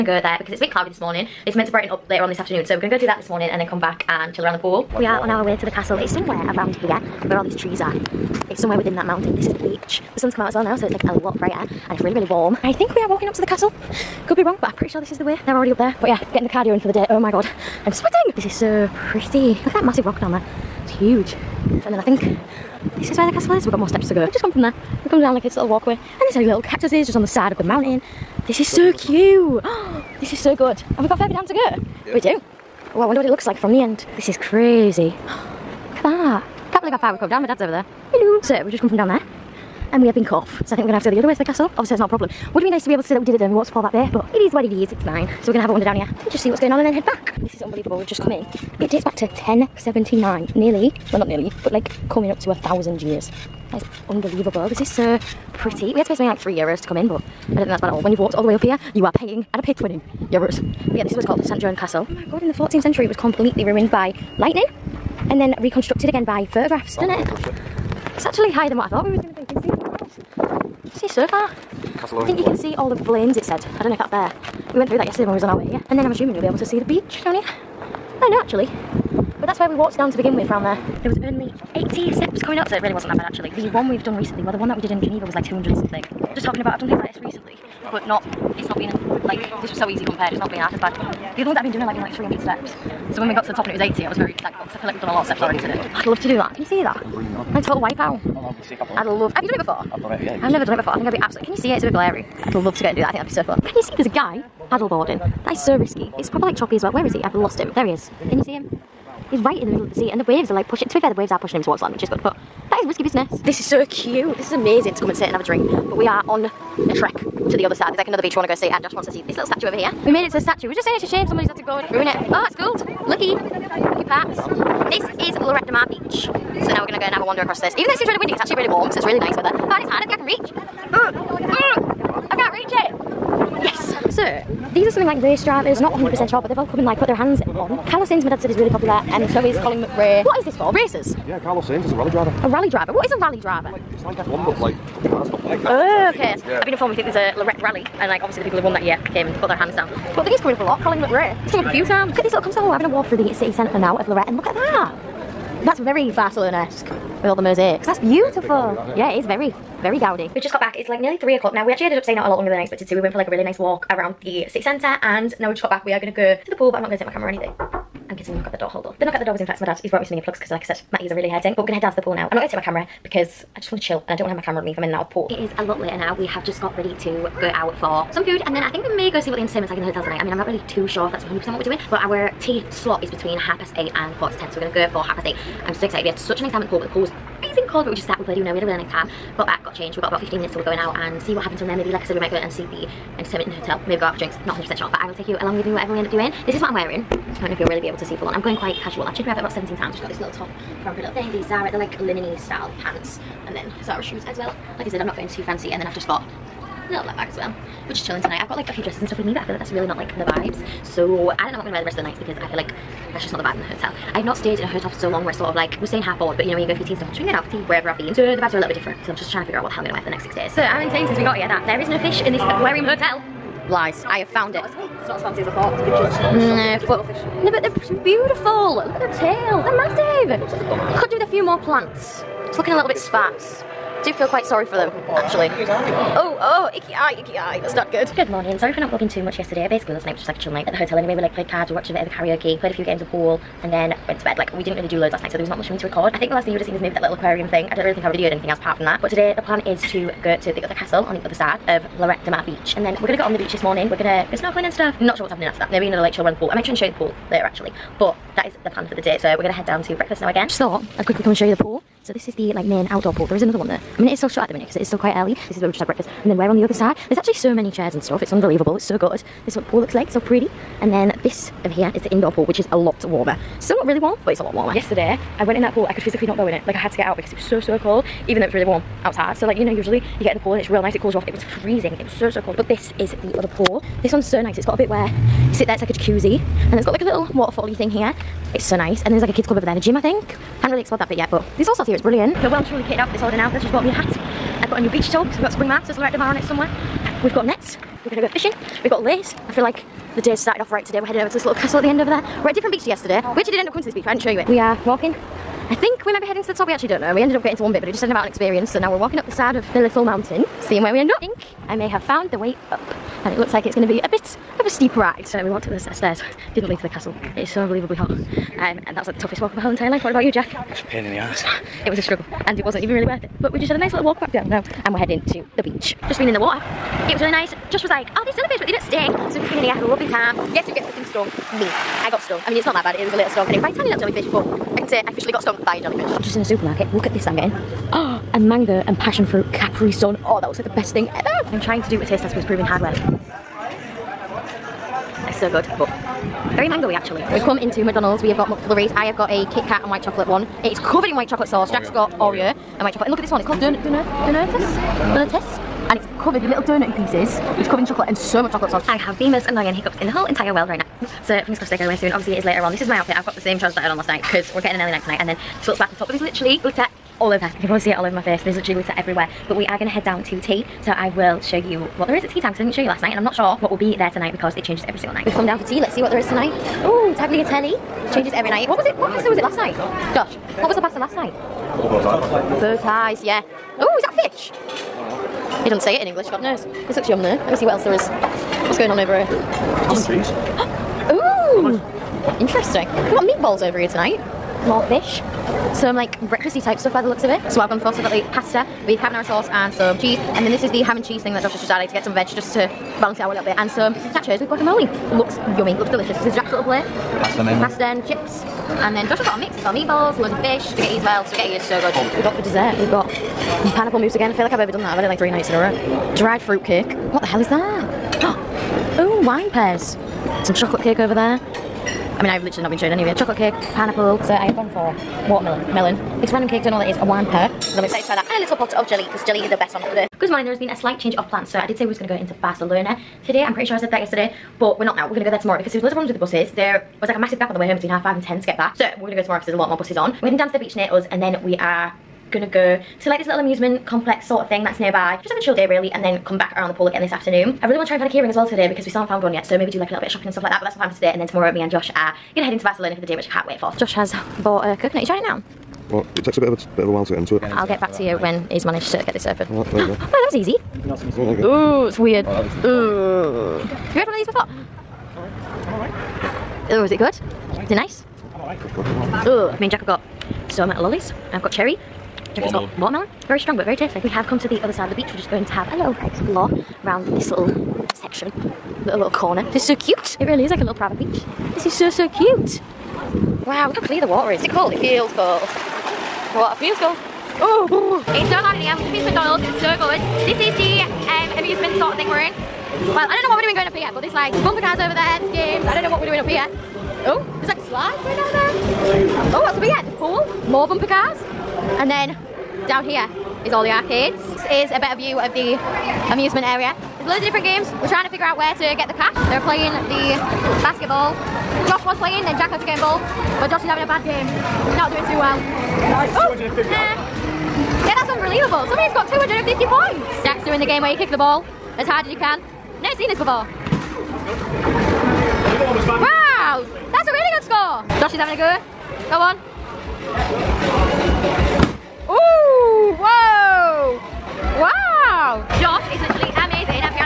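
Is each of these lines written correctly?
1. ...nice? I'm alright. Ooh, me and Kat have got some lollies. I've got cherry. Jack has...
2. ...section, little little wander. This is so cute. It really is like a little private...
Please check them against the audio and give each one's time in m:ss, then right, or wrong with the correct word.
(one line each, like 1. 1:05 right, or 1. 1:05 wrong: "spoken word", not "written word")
1. 7:47 wrong: "Jack", not "Kat"
2. 7:57 wrong: "corner", not "wander".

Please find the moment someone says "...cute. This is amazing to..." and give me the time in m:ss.
1:53.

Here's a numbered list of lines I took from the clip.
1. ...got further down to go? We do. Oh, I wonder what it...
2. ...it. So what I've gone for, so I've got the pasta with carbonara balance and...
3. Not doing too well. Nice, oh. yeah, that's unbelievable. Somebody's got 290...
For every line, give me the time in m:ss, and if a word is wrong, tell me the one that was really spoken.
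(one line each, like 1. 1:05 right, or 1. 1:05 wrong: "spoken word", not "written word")
1. 0:31 right
2. 6:37 wrong: "sauce", not "balance"
3. 8:34 wrong: "250", not "290".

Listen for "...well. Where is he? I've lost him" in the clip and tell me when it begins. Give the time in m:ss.
1:46.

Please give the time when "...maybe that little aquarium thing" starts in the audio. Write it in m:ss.
4:06.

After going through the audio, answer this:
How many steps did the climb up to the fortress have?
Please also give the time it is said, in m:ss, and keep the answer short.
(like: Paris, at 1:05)
80, at 1:21.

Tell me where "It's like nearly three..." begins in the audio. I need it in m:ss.
2:40.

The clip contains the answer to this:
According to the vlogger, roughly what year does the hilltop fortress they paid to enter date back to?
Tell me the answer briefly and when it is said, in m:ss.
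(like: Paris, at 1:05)
1079, at 0:49.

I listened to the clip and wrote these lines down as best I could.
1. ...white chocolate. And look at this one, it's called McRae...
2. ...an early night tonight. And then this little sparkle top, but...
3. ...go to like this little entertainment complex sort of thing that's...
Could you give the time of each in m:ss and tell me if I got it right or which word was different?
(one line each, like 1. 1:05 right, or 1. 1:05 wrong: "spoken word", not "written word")
1. 5:52 wrong: "Donut", not "McRae"
2. 6:04 right
3. 7:22 wrong: "amusement", not "entertainment".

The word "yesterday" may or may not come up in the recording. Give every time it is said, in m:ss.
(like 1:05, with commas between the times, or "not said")
1:15, 3:59, 4:34, 5:02, 7:13.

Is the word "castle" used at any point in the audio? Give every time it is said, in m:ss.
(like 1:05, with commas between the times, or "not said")
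0:05, 0:13, 0:23, 0:41, 1:01, 4:10, 5:01, 5:16.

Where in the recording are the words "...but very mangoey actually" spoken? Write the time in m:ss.
5:45.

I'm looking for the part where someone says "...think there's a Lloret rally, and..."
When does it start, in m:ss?
2:26.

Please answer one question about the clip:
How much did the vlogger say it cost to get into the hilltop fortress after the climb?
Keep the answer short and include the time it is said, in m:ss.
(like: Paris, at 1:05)
3 euros, at 0:56.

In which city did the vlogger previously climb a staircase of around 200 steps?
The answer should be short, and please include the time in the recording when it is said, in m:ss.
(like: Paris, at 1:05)
Geneva, at 1:24.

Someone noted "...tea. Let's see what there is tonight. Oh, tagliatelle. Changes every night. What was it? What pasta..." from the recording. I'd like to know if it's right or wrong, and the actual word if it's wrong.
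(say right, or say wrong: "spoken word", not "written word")
right.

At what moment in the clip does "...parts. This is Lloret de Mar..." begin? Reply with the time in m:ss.
2:04.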